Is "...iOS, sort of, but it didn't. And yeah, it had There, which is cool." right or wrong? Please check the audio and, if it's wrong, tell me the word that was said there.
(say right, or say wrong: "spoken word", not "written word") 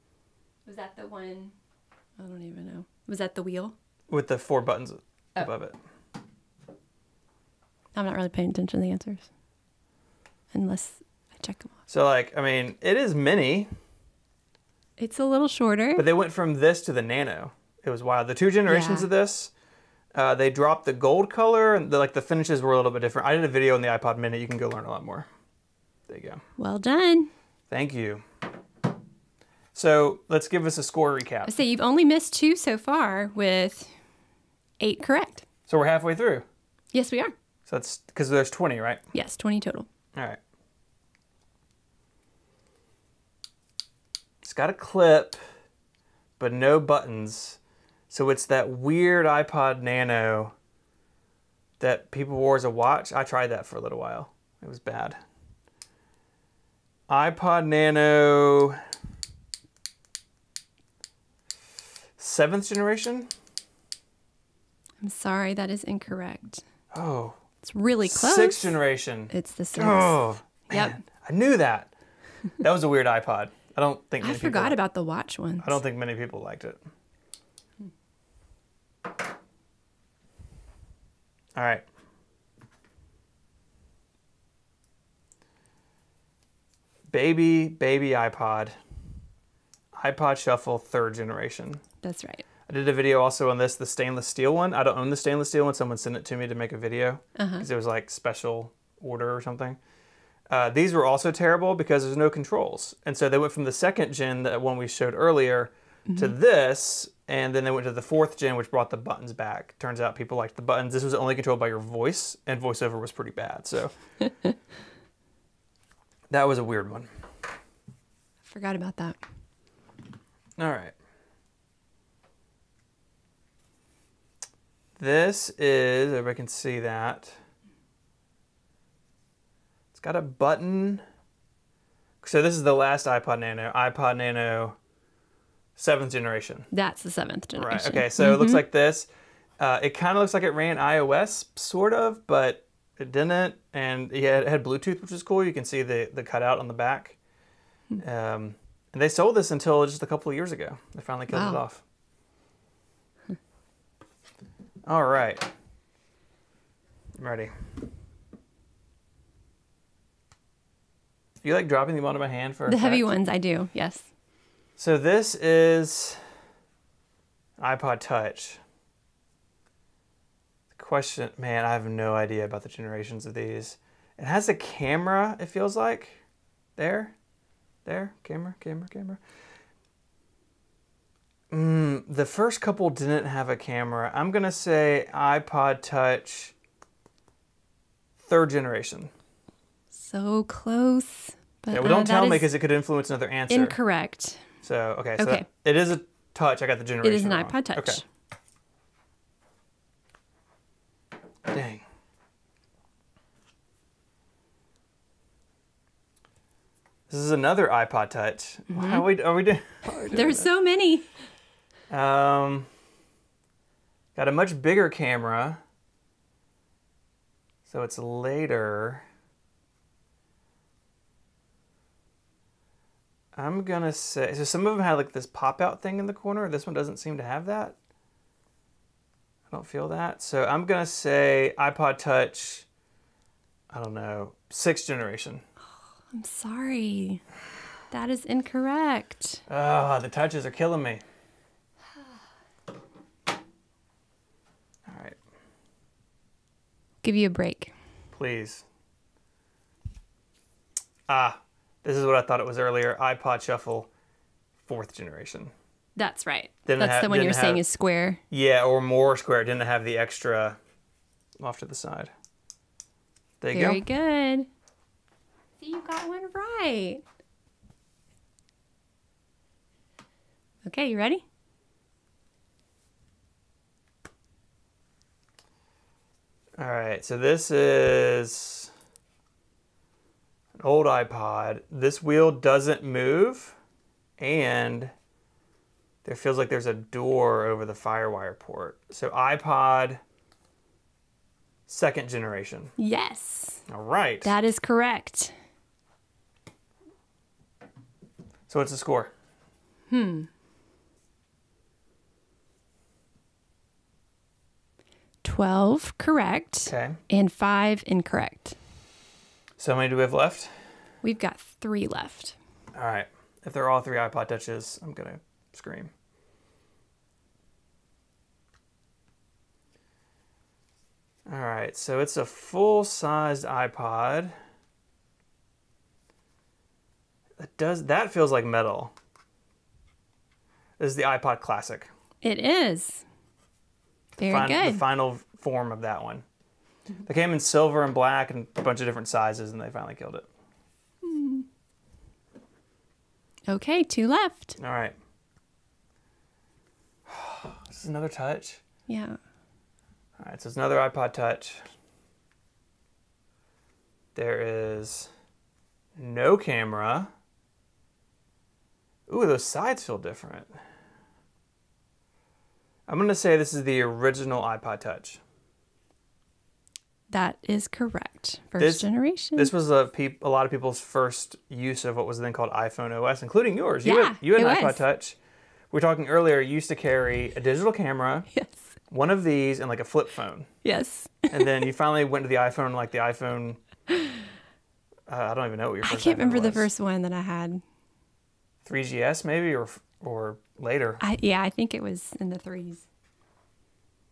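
wrong: "Bluetooth", not "There".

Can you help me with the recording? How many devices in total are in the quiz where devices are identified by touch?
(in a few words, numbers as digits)
20.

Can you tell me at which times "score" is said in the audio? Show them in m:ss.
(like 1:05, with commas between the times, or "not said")
0:30, 4:58.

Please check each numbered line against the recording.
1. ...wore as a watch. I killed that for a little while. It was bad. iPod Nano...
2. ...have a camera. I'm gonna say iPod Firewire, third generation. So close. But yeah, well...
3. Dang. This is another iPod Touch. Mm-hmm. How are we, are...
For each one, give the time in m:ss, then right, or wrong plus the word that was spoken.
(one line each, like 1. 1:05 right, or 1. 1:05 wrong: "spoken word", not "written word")
1. 0:52 wrong: "tried", not "killed"
2. 3:03 wrong: "Touch", not "Firewire"
3. 3:21 right.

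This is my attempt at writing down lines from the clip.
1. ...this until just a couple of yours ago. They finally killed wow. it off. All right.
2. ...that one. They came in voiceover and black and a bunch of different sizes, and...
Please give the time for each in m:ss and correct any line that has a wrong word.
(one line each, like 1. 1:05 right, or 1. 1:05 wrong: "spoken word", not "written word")
1. 2:29 wrong: "years", not "yours"
2. 5:35 wrong: "silver", not "voiceover".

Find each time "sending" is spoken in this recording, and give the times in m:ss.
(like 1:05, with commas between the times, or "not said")
not said.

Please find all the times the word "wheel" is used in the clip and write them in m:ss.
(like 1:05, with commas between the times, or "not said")
0:03, 4:42.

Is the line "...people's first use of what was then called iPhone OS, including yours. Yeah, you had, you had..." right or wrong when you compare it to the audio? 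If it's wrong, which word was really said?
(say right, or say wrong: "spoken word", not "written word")
right.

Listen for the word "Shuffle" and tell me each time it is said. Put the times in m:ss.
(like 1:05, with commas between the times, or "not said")
1:30, 4:13.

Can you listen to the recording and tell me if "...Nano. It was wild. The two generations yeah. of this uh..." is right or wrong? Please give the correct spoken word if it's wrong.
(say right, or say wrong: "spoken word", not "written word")
right.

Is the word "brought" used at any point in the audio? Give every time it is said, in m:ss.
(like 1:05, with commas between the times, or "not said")
1:48.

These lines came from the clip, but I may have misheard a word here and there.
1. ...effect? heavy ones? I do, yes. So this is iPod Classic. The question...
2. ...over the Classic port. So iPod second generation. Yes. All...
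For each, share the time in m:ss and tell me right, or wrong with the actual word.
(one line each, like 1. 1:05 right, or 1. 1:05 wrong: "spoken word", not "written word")
1. 2:42 wrong: "Touch", not "Classic"
2. 4:47 wrong: "Firewire", not "Classic".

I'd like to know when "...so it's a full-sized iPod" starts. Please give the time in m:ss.
5:21.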